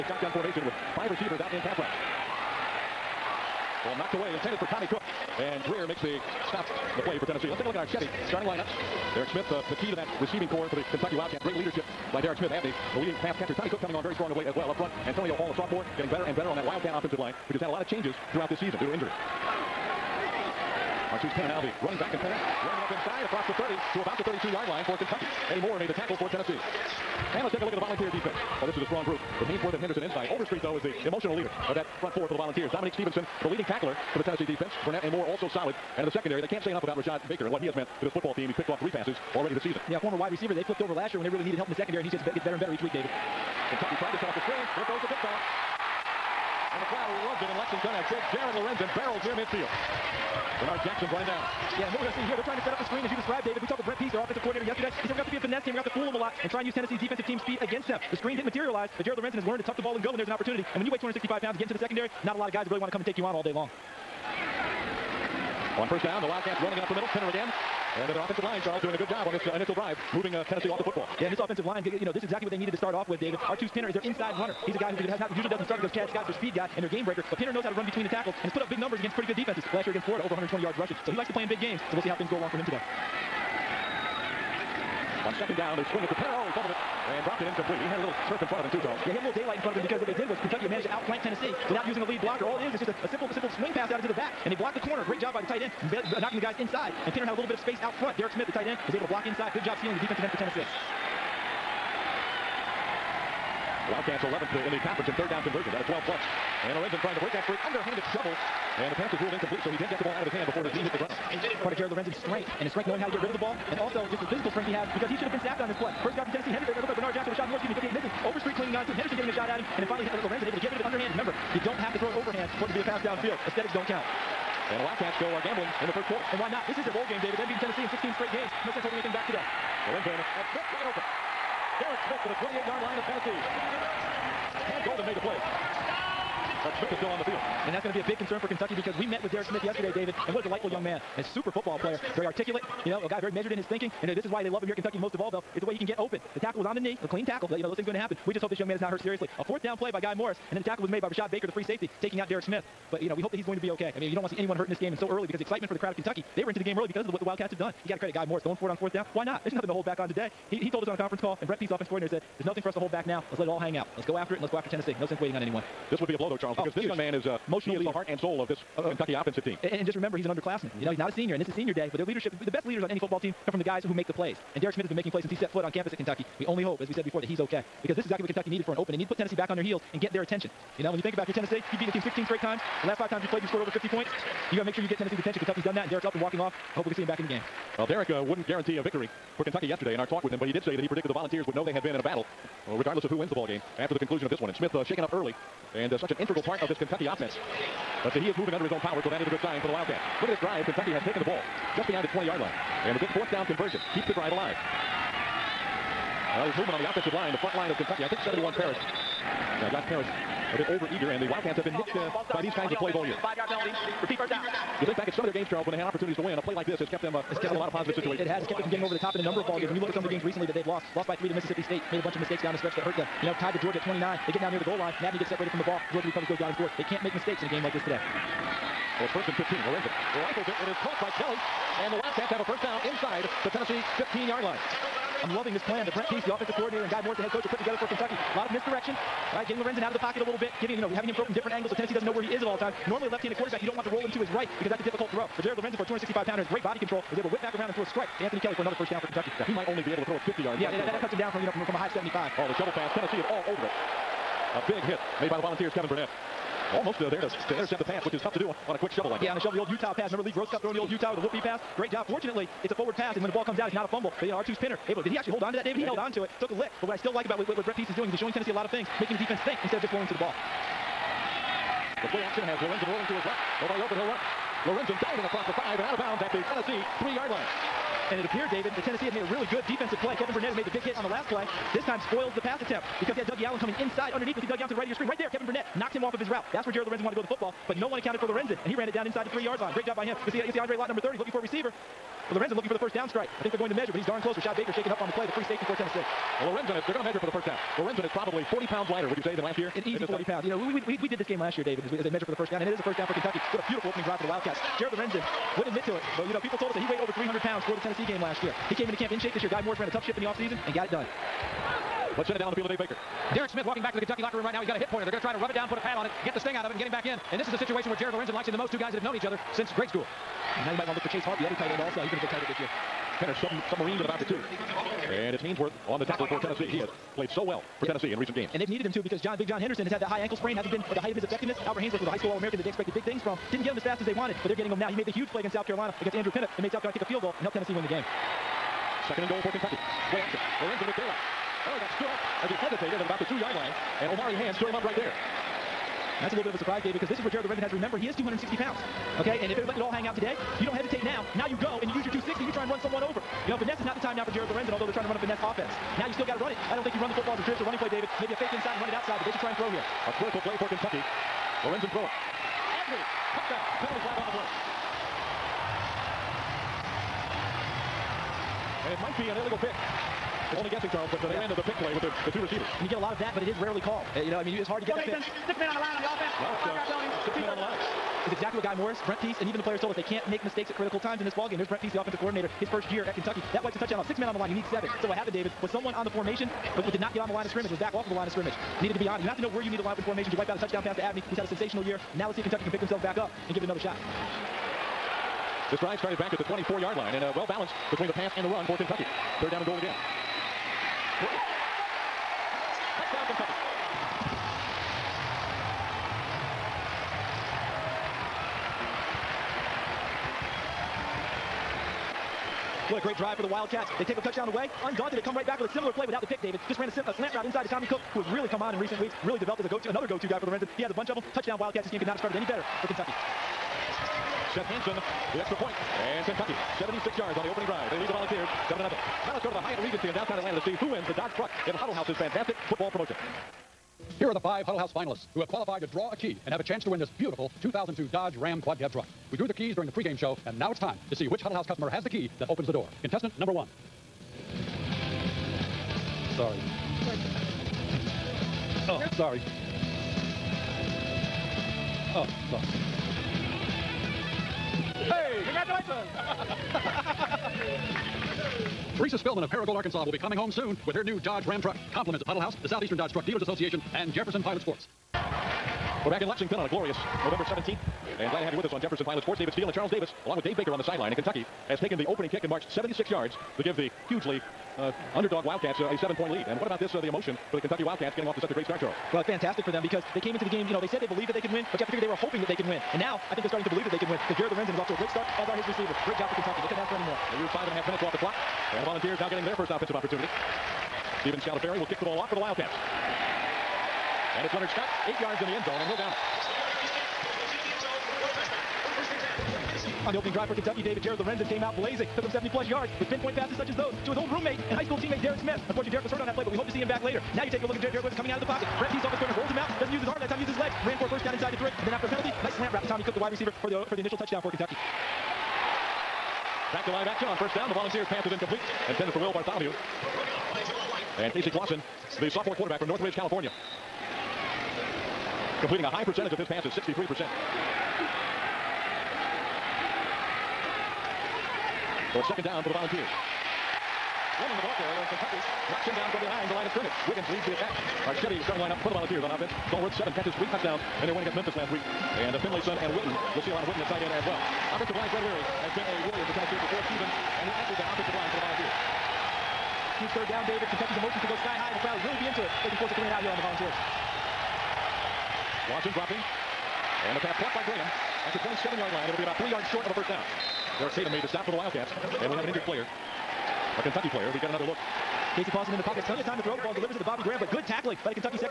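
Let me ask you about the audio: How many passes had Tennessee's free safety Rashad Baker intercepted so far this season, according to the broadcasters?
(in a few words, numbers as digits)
3.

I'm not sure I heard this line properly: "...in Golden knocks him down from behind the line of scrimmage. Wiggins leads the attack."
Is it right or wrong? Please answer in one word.
wrong.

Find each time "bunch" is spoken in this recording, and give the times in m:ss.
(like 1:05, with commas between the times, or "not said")
3:42, 7:00.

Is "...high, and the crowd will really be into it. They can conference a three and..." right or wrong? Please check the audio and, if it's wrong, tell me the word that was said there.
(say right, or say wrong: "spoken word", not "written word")
wrong: "force", not "conference".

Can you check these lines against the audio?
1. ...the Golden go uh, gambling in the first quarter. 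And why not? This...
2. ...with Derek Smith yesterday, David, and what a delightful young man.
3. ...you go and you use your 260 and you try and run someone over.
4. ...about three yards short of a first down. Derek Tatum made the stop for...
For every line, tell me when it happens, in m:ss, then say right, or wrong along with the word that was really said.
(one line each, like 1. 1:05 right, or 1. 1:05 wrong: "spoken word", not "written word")
1. 2:04 wrong: "Wildcats", not "Golden"
2. 2:19 right
3. 5:51 right
4. 9:19 right.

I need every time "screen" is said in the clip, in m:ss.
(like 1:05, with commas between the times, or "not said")
0:44, 0:52, 0:58, 4:44.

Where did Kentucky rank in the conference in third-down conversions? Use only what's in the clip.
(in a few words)
11th.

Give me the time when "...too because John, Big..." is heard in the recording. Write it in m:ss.
5:28.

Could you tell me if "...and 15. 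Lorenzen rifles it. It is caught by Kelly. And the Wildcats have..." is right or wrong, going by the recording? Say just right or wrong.
right.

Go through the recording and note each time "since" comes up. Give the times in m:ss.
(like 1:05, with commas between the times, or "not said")
2:55, 5:19.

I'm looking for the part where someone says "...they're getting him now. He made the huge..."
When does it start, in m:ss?
5:34.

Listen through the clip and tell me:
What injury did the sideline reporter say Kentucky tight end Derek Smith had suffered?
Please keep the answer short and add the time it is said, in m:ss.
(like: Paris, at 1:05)
Hip pointer, at 5:14.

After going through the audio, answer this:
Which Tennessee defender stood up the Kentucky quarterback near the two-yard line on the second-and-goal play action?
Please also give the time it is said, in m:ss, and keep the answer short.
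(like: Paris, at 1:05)
Omari Hand, at 5:44.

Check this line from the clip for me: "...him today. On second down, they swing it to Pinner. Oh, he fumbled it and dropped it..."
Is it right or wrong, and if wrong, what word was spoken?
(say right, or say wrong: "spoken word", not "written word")
right.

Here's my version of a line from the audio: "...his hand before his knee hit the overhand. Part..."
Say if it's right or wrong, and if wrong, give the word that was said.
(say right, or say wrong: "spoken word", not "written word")
wrong: "ground", not "overhand".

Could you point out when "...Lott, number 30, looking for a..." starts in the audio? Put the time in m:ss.
4:50.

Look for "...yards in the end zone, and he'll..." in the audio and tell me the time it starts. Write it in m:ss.
8:15.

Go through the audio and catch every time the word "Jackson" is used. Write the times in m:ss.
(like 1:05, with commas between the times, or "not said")
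0:50, 1:57.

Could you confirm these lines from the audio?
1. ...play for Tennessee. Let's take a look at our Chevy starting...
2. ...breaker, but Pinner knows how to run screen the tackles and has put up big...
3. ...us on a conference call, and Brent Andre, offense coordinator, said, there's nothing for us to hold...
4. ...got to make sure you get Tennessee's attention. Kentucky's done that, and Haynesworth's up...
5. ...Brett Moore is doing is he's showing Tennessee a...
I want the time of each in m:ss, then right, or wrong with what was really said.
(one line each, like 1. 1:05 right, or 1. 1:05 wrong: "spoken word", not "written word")
1. 0:07 right
2. 1:17 wrong: "between", not "screen"
3. 2:40 wrong: "Pease", not "Andre"
4. 3:04 wrong: "Derek", not "Haynesworth"
5. 4:27 wrong: "Pease", not "Moore".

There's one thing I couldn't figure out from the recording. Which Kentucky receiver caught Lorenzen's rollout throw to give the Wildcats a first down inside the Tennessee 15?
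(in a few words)
Anthony Kelly.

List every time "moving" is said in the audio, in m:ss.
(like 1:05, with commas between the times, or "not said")
1:10, 3:18.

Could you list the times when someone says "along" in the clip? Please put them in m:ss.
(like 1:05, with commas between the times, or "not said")
1:22, 7:50.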